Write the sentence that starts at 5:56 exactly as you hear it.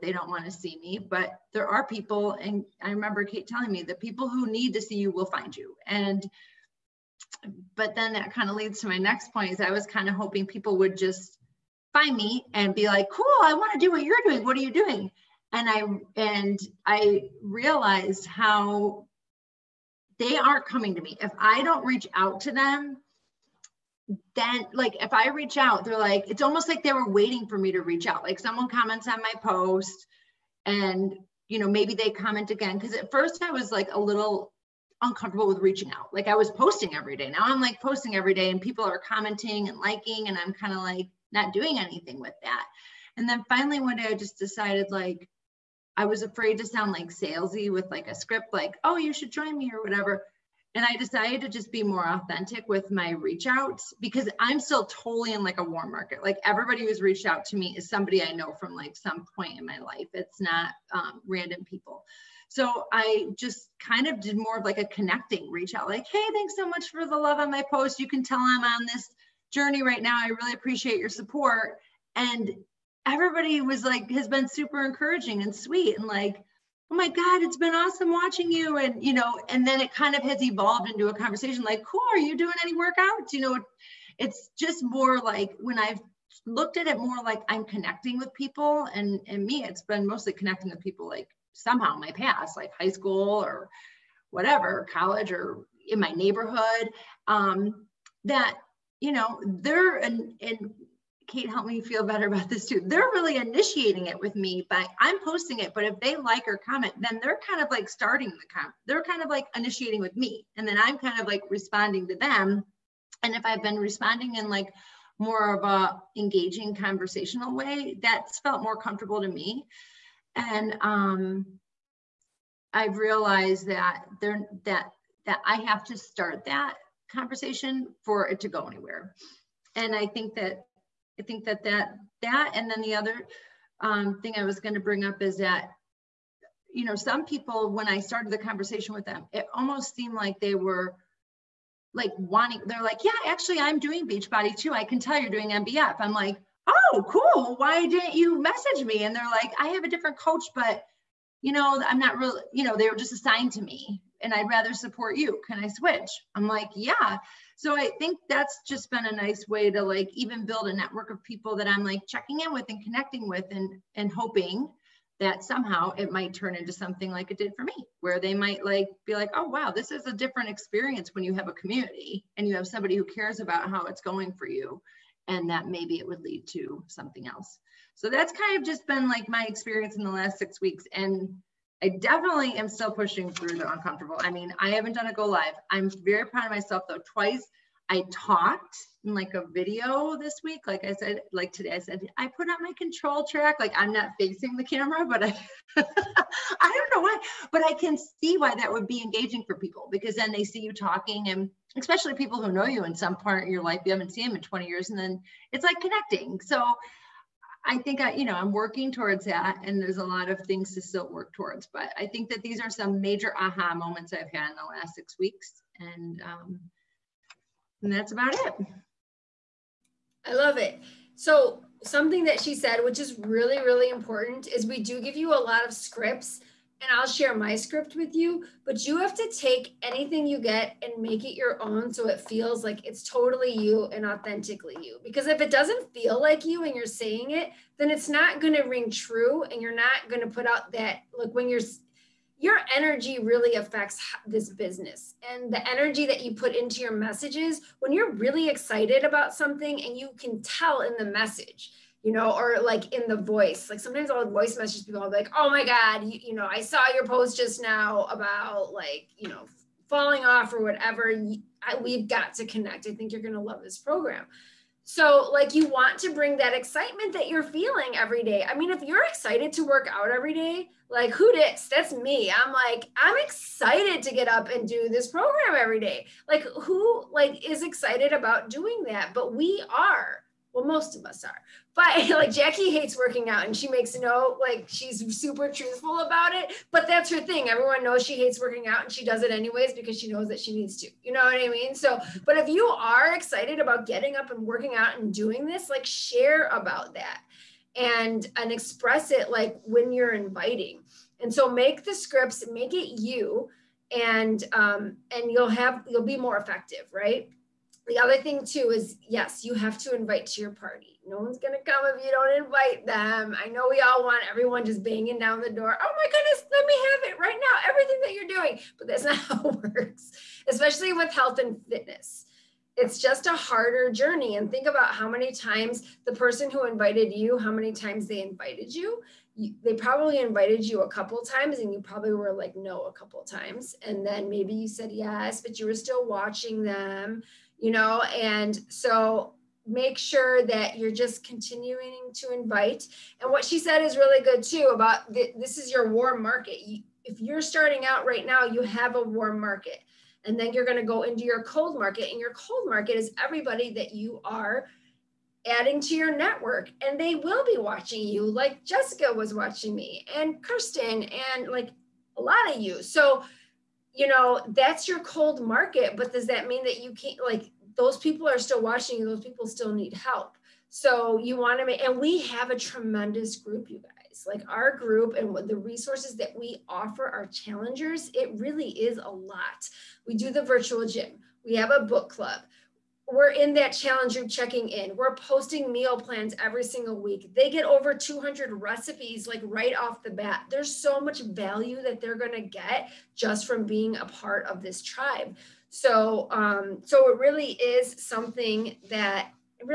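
And they will be watching you, like Jessica was watching me, and Kirsten, and like a lot of you.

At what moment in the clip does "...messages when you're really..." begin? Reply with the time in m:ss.
4:06.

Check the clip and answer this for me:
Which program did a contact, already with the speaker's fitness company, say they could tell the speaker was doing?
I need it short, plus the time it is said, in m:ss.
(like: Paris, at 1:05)
MBF, at 2:25.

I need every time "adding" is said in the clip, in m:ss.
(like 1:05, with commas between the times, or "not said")
5:55.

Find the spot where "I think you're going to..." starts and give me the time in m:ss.
4:22.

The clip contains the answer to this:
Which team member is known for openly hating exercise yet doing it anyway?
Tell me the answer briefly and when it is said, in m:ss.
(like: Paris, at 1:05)
Jackie, at 4:42.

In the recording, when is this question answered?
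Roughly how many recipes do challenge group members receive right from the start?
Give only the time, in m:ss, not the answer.
6:27.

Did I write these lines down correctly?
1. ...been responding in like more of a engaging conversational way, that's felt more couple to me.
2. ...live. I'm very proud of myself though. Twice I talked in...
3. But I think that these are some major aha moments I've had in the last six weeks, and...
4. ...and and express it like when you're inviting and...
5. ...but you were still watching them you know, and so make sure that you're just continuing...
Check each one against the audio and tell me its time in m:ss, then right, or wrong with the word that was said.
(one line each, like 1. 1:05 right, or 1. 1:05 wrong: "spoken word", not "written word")
1. 1:53 wrong: "comfortable", not "couple"
2. 3:05 right
3. 3:31 right
4. 4:57 right
5. 5:35 right.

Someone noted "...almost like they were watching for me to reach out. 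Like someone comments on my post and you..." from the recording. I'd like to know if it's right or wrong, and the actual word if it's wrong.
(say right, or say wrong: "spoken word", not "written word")
wrong: "waiting", not "watching".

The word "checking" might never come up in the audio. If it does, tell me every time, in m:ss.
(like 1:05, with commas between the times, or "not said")
2:42, 6:24.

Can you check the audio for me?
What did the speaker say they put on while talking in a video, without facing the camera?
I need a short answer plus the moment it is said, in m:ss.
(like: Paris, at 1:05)
control track, at 3:12.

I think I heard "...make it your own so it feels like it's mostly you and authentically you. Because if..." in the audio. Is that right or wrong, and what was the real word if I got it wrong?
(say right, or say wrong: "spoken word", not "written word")
wrong: "totally", not "mostly".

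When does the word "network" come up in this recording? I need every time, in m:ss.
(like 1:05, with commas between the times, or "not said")
2:40, 5:56.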